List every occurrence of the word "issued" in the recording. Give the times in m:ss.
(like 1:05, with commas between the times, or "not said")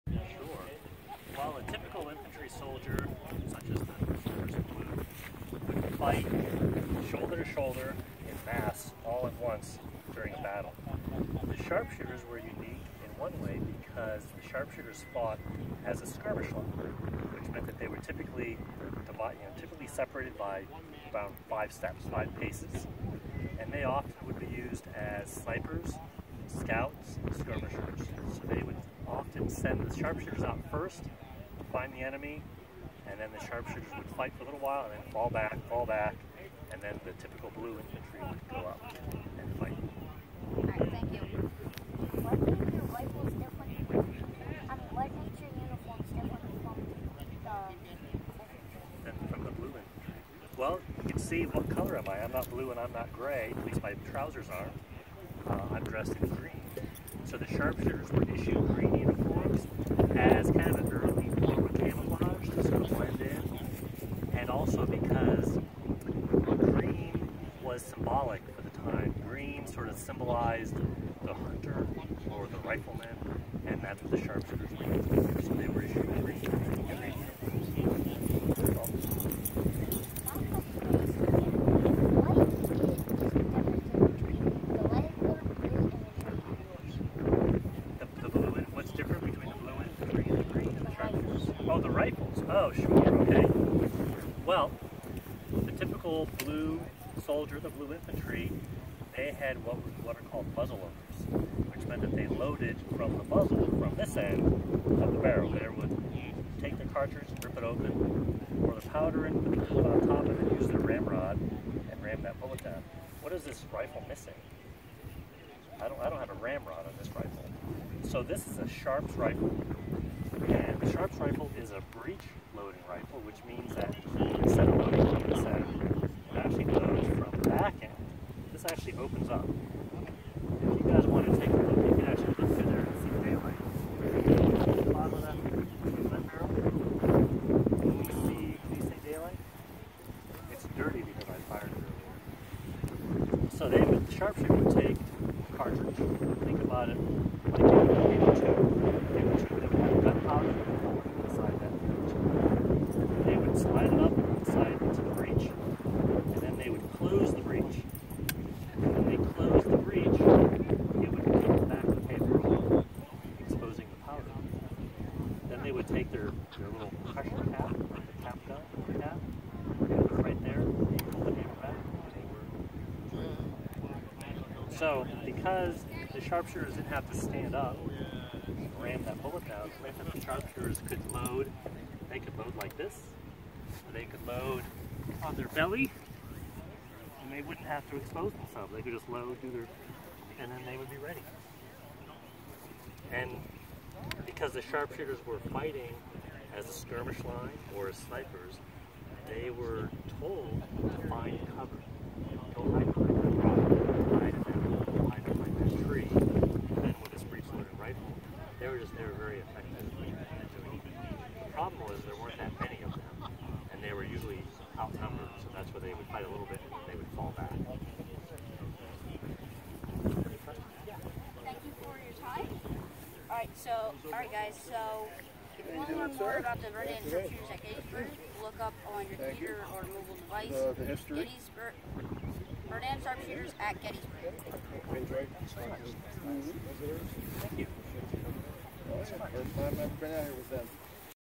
0:58, 1:15.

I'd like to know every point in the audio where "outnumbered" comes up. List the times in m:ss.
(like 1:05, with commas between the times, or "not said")
3:34.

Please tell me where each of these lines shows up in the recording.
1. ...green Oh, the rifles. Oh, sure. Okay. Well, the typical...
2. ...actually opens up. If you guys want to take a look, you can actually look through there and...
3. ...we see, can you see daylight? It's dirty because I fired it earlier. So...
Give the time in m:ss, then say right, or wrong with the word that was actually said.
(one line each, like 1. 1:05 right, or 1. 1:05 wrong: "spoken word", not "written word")
1. 1:30 right
2. 2:08 right
3. 2:17 right.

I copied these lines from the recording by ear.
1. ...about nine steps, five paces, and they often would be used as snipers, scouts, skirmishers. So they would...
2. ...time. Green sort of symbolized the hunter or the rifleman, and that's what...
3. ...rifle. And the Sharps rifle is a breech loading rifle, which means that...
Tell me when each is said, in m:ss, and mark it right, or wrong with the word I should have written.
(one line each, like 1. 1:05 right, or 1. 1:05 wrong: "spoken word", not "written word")
1. 0:21 wrong: "five", not "nine"
2. 1:08 right
3. 1:59 right.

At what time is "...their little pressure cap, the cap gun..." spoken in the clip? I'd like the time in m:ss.
2:46.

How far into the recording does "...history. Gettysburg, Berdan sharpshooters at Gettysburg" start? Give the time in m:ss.
3:50.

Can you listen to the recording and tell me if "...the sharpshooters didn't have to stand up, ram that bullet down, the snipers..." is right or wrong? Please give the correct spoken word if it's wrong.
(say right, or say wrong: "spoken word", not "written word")
wrong: "sharpshooters", not "snipers".